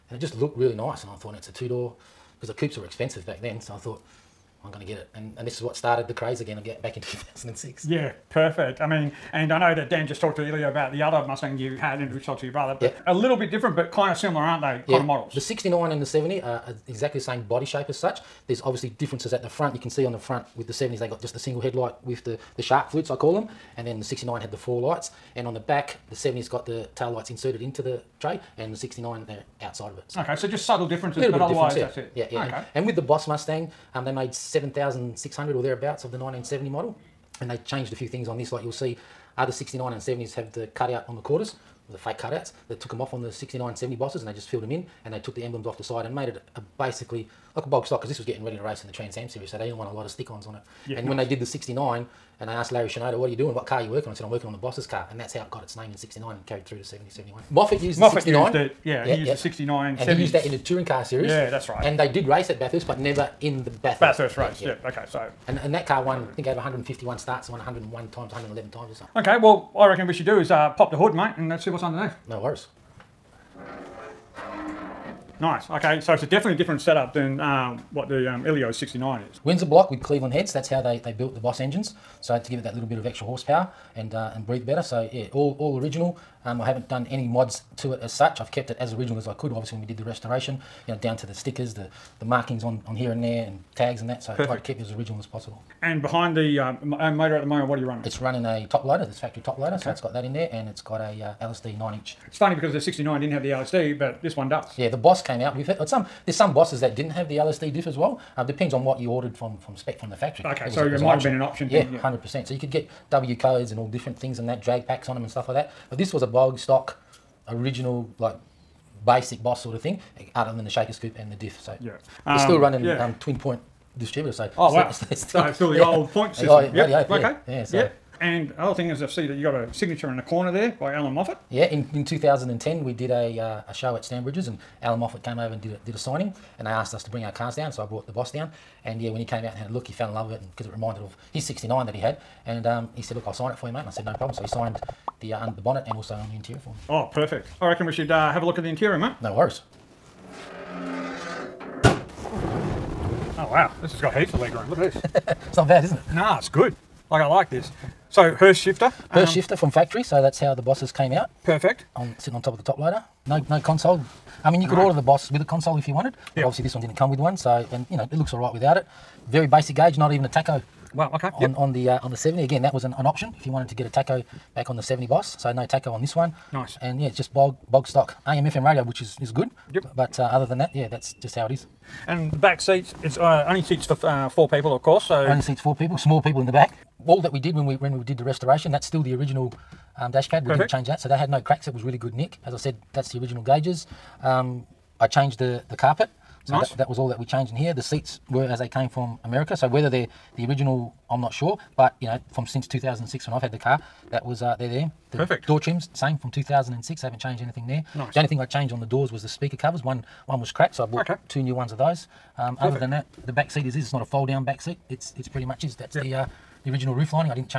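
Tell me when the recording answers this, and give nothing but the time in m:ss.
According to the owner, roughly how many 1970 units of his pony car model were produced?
0:34.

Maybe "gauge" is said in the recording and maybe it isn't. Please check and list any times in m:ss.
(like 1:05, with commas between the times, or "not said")
2:49, 3:13.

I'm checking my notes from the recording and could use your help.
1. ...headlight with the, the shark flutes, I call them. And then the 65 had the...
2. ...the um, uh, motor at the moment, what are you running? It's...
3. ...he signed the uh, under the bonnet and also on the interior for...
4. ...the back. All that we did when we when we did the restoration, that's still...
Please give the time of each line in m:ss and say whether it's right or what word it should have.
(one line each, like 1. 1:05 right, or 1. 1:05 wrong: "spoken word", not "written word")
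1. 0:21 wrong: "69", not "65"
2. 1:36 right
3. 2:24 right
4. 3:06 right.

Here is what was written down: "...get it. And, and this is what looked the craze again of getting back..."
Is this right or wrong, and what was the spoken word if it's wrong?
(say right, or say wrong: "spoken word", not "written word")
wrong: "started", not "looked".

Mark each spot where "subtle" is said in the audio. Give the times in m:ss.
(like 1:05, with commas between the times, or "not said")
0:30.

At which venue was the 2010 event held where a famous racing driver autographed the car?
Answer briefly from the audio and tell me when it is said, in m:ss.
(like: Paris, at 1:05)
Stanbridges, at 2:14.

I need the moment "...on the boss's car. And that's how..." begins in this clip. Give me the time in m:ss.
0:54.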